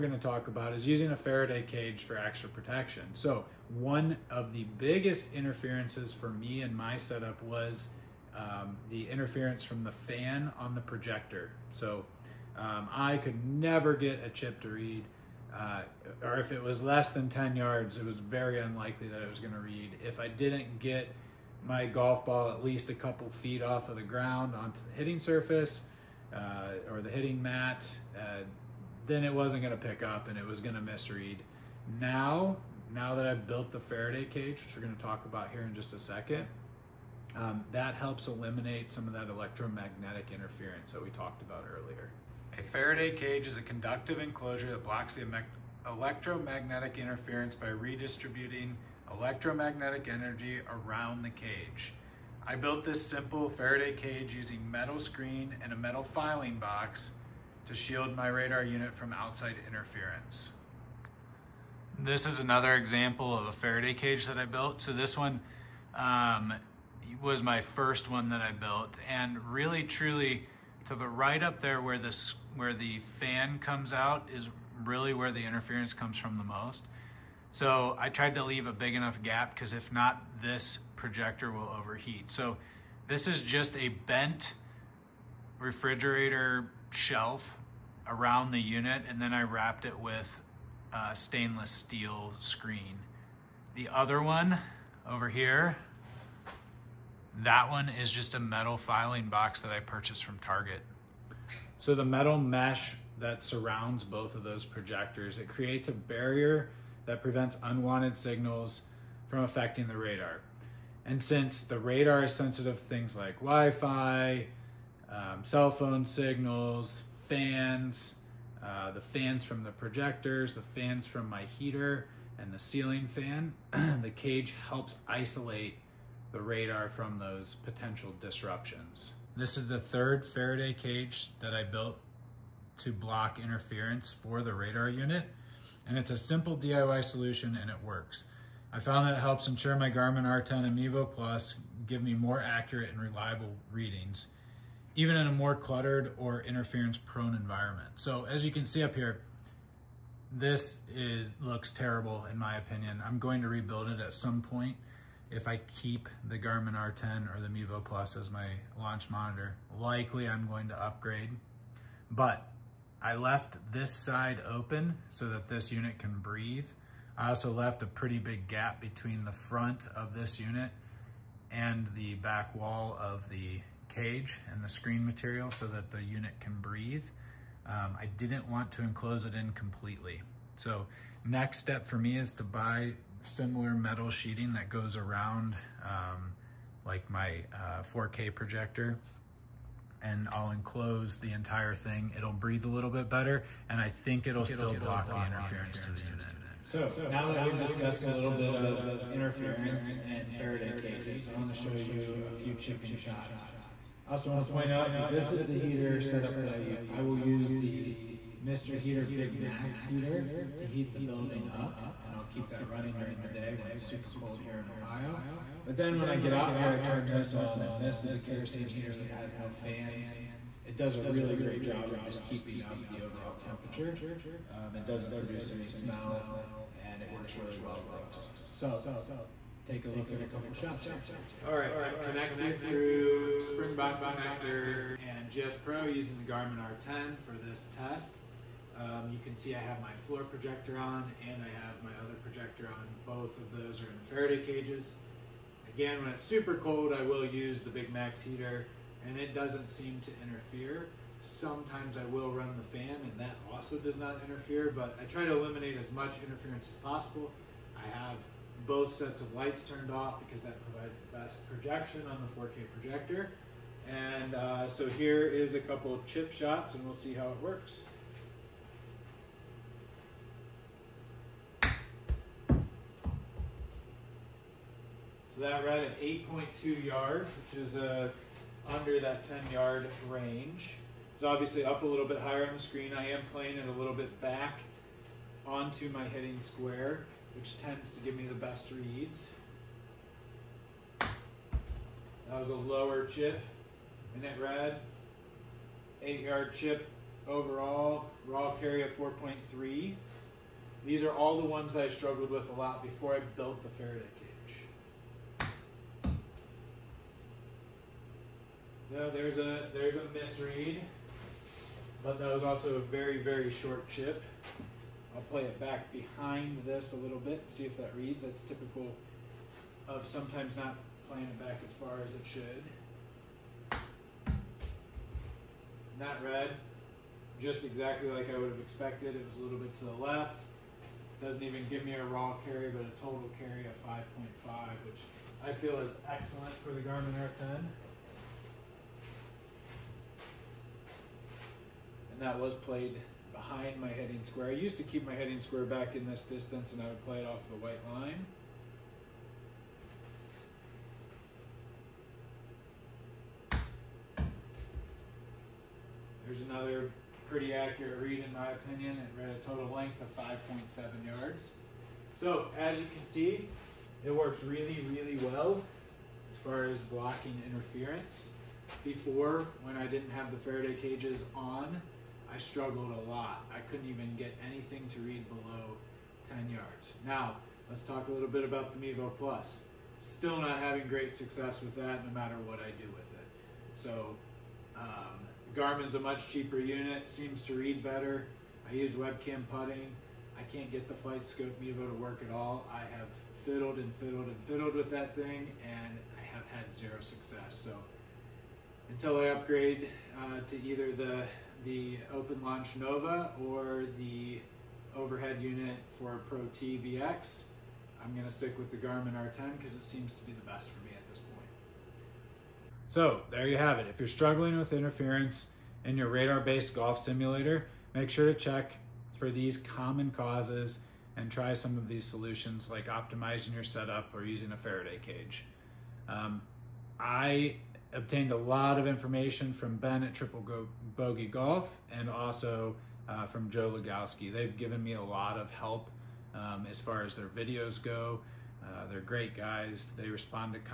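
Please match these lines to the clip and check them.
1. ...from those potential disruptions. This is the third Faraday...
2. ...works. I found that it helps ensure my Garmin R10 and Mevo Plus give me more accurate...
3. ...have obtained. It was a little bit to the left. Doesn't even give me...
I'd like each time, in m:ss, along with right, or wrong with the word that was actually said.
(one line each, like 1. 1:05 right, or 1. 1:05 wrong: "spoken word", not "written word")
1. 2:06 right
2. 2:17 right
3. 5:28 wrong: "expected", not "obtained".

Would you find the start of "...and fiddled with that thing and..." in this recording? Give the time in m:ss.
6:34.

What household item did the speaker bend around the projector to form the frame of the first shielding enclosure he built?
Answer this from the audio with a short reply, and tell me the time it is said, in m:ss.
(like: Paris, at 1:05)
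refrigerator shelf, at 1:25.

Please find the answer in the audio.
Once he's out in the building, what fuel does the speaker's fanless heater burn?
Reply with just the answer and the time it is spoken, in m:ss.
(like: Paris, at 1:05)
kerosene, at 3:38.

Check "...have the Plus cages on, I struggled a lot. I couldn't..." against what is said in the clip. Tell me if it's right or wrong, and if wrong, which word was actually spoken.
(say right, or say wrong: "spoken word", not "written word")
wrong: "Faraday", not "Plus".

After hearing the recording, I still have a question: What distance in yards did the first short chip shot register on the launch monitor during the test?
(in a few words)
8.2 yards.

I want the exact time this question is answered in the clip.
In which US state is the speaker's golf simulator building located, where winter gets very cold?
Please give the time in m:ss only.
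3:34.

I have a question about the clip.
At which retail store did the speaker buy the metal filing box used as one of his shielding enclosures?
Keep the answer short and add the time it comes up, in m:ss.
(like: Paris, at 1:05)
Target, at 1:40.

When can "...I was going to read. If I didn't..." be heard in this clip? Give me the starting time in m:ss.
0:19.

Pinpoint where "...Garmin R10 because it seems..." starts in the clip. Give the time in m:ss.
6:48.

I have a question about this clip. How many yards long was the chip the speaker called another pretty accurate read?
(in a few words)
5.7 yards.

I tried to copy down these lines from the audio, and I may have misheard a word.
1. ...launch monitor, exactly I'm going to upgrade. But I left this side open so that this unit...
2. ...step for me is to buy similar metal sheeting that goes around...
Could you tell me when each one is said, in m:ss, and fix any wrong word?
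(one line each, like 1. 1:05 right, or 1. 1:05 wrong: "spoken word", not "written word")
1. 2:38 wrong: "likely", not "exactly"
2. 3:01 right.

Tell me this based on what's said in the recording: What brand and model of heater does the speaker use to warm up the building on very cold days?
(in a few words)
Mr. Heater Big Max.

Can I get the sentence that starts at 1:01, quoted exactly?
This is another example of a Faraday cage that I built.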